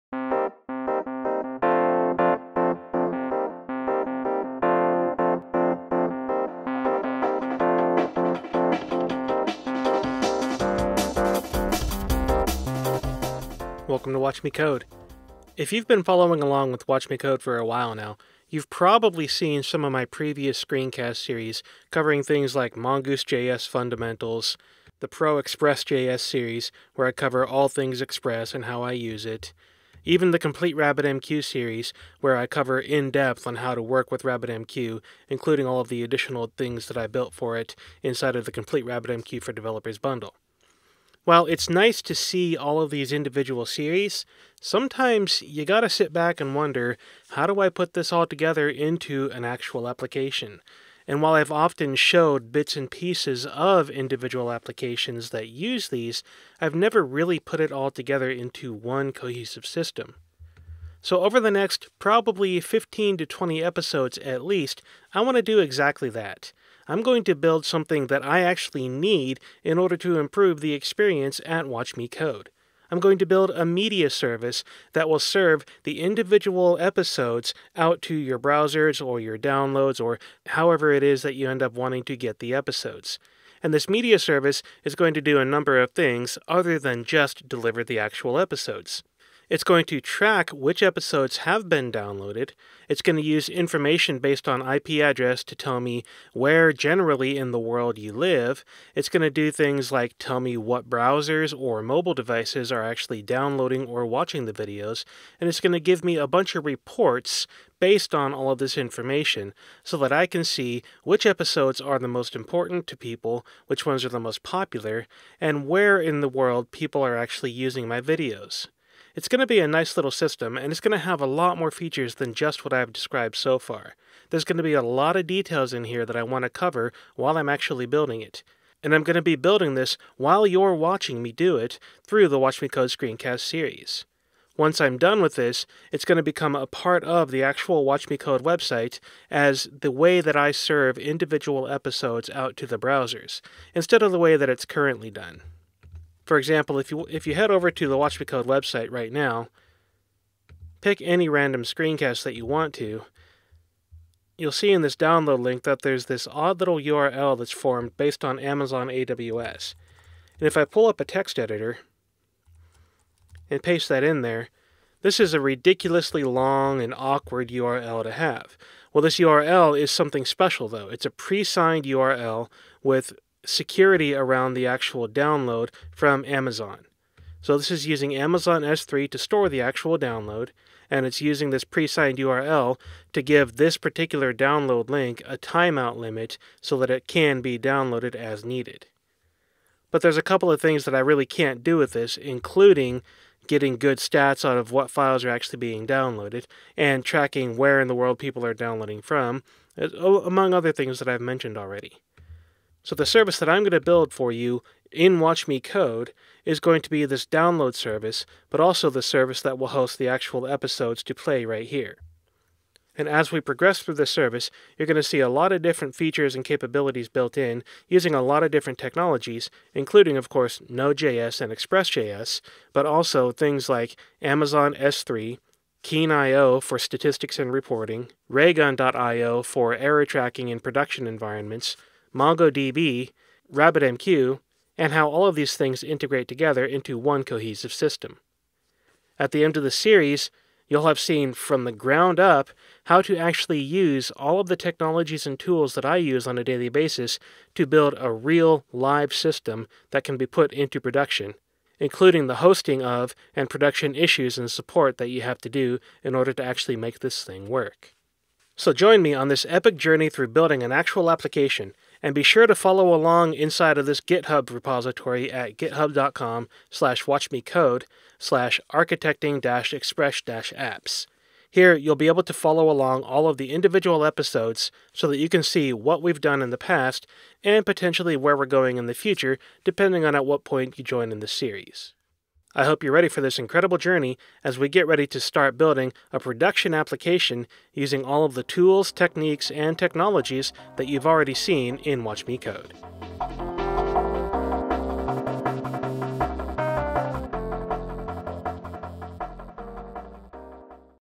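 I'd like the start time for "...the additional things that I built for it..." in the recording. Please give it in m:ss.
0:35.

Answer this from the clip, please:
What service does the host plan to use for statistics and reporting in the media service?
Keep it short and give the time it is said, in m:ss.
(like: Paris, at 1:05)
Keen.io, at 3:45.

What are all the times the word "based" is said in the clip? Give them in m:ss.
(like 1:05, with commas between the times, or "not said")
1:34, 1:47, 2:37.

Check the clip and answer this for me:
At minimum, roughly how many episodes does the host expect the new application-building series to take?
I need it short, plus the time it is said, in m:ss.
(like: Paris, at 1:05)
15 to 20, at 1:02.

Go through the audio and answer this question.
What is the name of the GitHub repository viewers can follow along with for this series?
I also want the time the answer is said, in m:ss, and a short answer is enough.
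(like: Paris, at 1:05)
architecting-express-apps, at 4:28.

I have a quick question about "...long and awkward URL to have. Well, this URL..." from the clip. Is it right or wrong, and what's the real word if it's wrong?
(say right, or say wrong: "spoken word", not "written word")
right.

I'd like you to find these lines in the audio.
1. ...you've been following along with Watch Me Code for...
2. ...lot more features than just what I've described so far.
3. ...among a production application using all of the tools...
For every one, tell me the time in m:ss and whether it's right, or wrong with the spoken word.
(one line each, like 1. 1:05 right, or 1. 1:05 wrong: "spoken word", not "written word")
1. 0:15 right
2. 2:01 right
3. 4:45 wrong: "building", not "among".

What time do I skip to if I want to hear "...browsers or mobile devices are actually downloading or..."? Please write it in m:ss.
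1:40.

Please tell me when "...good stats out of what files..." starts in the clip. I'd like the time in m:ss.
3:13.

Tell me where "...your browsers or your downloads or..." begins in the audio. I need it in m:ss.
1:18.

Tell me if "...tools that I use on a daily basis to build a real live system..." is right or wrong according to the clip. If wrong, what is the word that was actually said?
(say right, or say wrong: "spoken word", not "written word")
right.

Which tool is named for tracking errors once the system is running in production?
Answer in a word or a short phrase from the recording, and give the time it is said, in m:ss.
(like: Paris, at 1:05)
Raygun.io, at 3:48.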